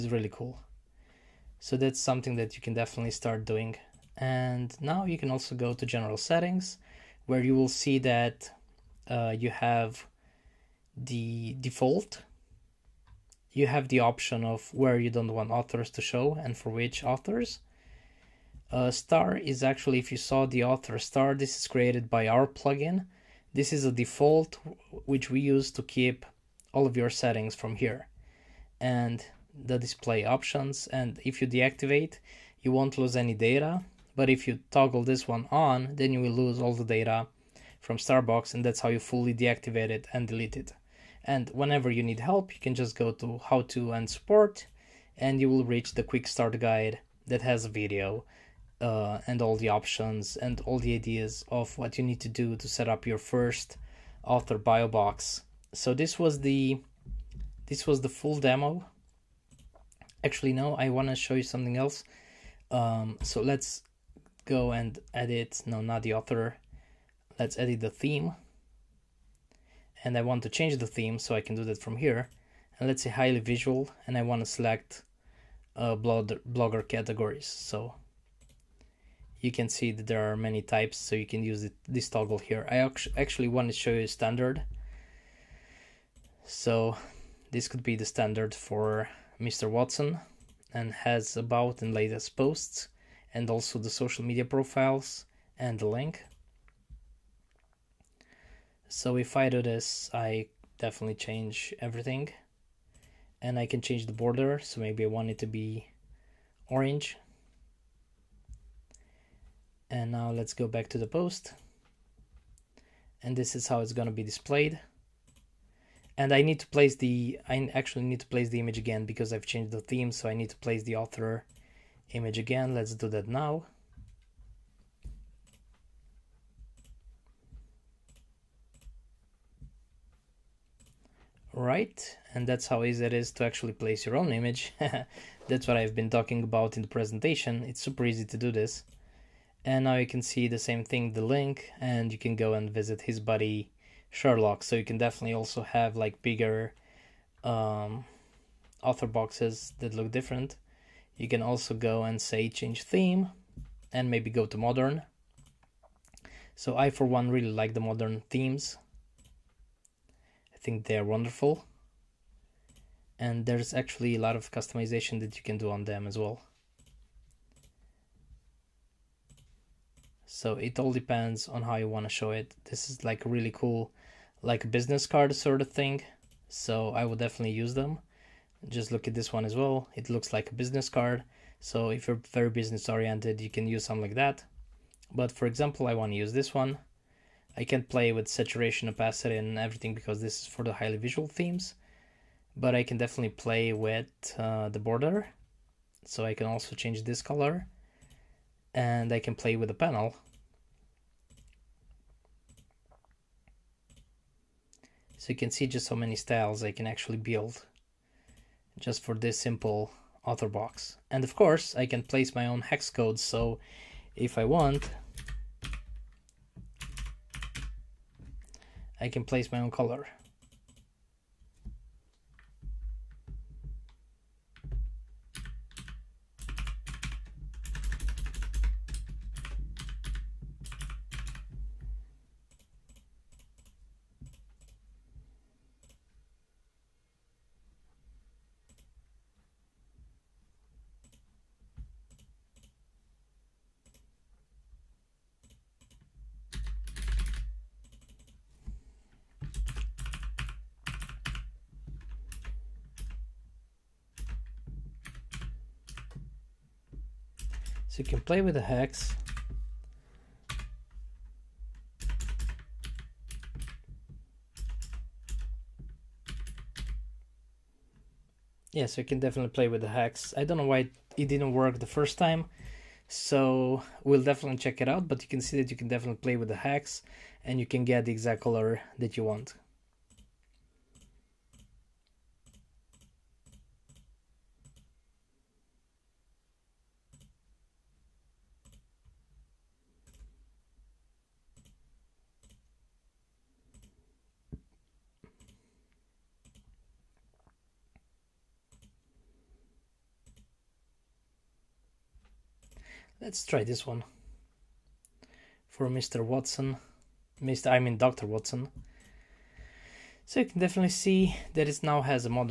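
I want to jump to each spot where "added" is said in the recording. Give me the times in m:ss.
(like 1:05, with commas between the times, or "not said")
not said.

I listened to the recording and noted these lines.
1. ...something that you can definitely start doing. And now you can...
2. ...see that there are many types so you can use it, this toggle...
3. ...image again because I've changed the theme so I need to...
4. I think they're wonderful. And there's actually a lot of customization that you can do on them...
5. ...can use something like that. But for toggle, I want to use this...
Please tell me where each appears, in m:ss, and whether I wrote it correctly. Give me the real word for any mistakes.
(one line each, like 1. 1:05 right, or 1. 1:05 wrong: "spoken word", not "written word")
1. 0:02 right
2. 1:19 right
3. 1:58 right
4. 2:40 right
5. 3:03 wrong: "example", not "toggle".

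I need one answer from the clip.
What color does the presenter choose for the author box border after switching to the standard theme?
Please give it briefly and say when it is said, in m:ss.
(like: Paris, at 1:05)
orange, at 1:46.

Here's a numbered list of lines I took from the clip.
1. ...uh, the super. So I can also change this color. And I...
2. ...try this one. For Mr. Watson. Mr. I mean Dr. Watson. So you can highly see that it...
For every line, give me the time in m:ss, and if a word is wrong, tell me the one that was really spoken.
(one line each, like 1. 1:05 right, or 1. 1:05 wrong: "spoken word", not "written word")
1. 3:14 wrong: "border", not "super"
2. 5:03 wrong: "definitely", not "highly".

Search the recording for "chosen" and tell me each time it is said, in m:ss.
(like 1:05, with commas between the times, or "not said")
not said.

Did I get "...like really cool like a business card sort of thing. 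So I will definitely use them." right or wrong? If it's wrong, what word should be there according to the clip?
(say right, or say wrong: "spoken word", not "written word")
right.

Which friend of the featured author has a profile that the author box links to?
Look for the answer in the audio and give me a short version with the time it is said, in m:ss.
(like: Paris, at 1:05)
Sherlock, at 2:24.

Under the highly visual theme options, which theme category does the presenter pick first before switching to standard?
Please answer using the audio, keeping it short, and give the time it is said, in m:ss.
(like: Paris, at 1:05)
blogger categories, at 1:16.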